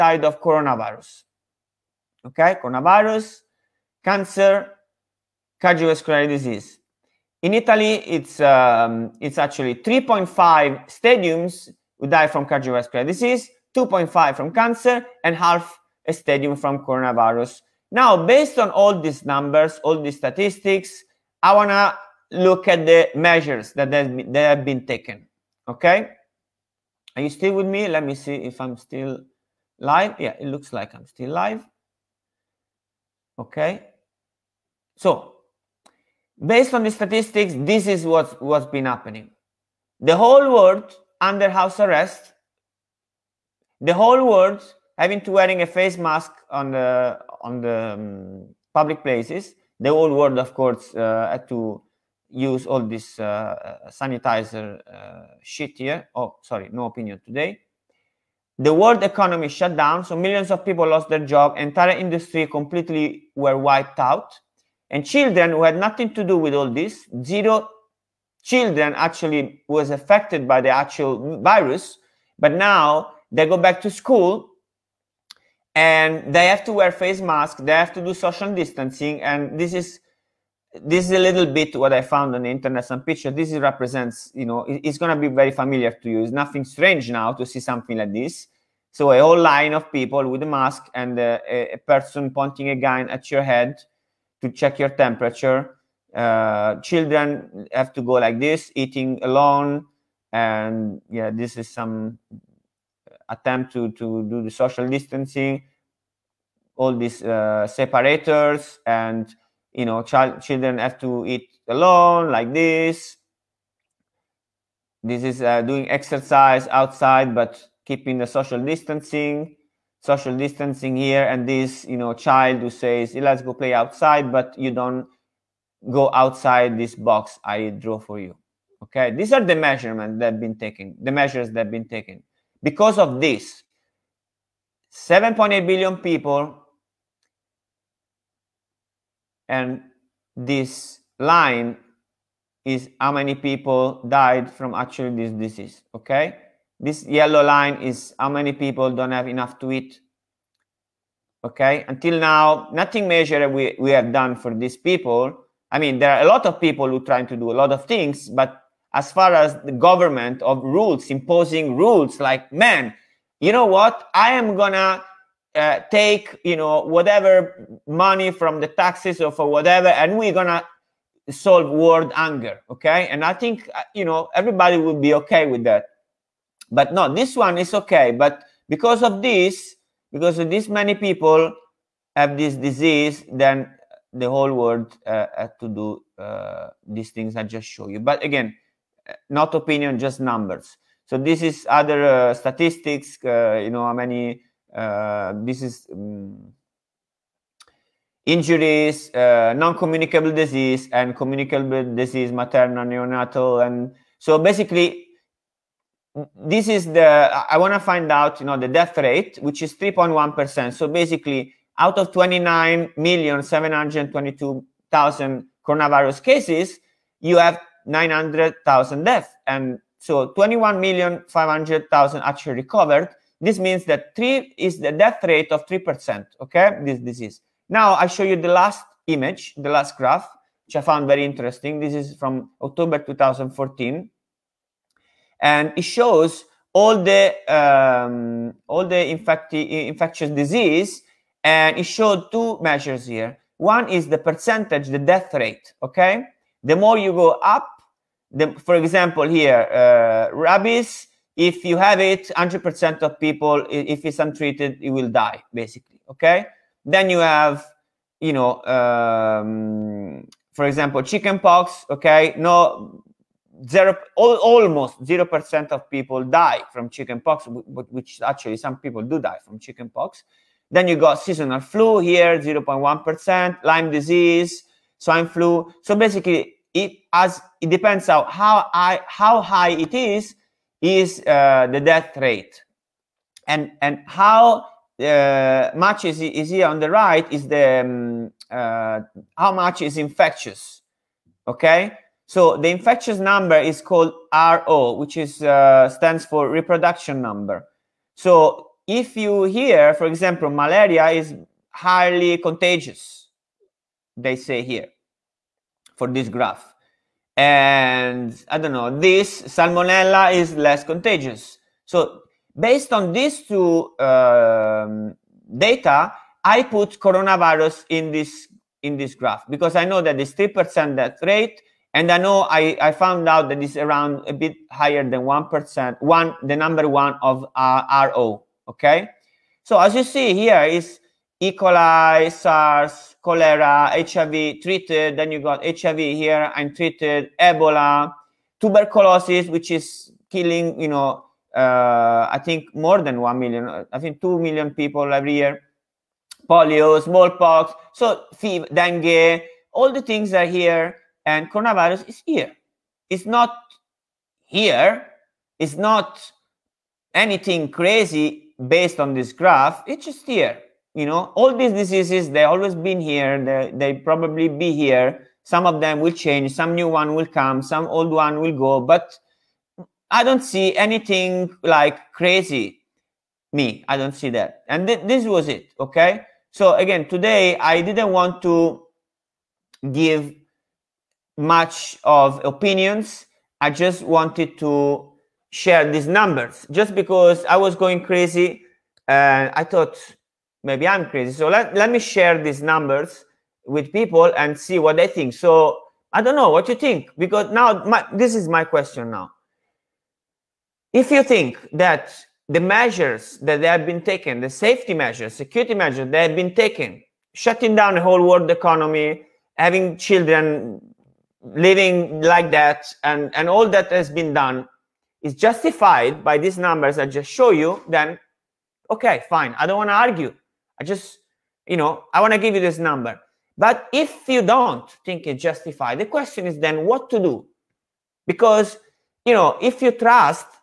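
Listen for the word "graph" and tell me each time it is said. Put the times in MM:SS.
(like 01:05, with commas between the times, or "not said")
03:49, 05:06, 05:19, 05:59.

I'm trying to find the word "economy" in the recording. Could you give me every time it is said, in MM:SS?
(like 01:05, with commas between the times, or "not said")
00:59, 06:48.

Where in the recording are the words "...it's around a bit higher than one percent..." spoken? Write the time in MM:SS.
05:23.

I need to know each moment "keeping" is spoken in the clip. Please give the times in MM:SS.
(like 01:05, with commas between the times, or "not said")
01:57.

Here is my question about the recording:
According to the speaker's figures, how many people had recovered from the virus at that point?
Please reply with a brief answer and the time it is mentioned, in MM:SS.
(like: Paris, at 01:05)
21,500,000, at 03:40.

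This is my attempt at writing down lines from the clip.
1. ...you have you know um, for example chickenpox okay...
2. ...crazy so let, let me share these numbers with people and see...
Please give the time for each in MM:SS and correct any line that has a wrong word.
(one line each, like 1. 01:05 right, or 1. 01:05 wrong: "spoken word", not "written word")
1. 04:17 right
2. 06:31 right.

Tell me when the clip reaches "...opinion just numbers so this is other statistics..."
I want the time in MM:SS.
03:09.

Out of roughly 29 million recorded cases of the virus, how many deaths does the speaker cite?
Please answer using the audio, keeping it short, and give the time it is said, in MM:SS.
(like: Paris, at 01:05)
900,000, at 03:37.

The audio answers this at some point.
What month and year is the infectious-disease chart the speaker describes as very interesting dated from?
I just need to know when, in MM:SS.
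03:52.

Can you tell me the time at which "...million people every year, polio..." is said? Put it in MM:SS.
05:44.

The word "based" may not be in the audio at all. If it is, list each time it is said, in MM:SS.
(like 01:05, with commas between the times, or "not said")
00:18, 00:36, 05:12, 05:58.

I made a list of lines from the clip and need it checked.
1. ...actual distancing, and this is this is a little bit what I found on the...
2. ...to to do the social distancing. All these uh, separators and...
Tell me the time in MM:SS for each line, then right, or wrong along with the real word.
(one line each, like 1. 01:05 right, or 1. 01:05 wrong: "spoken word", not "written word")
1. 01:18 wrong: "social", not "actual"
2. 01:43 right.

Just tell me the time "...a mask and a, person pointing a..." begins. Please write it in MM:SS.
01:30.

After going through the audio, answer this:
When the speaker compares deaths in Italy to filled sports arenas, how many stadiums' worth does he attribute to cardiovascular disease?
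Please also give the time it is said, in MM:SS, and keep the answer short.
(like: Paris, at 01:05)
3.5, at 00:09.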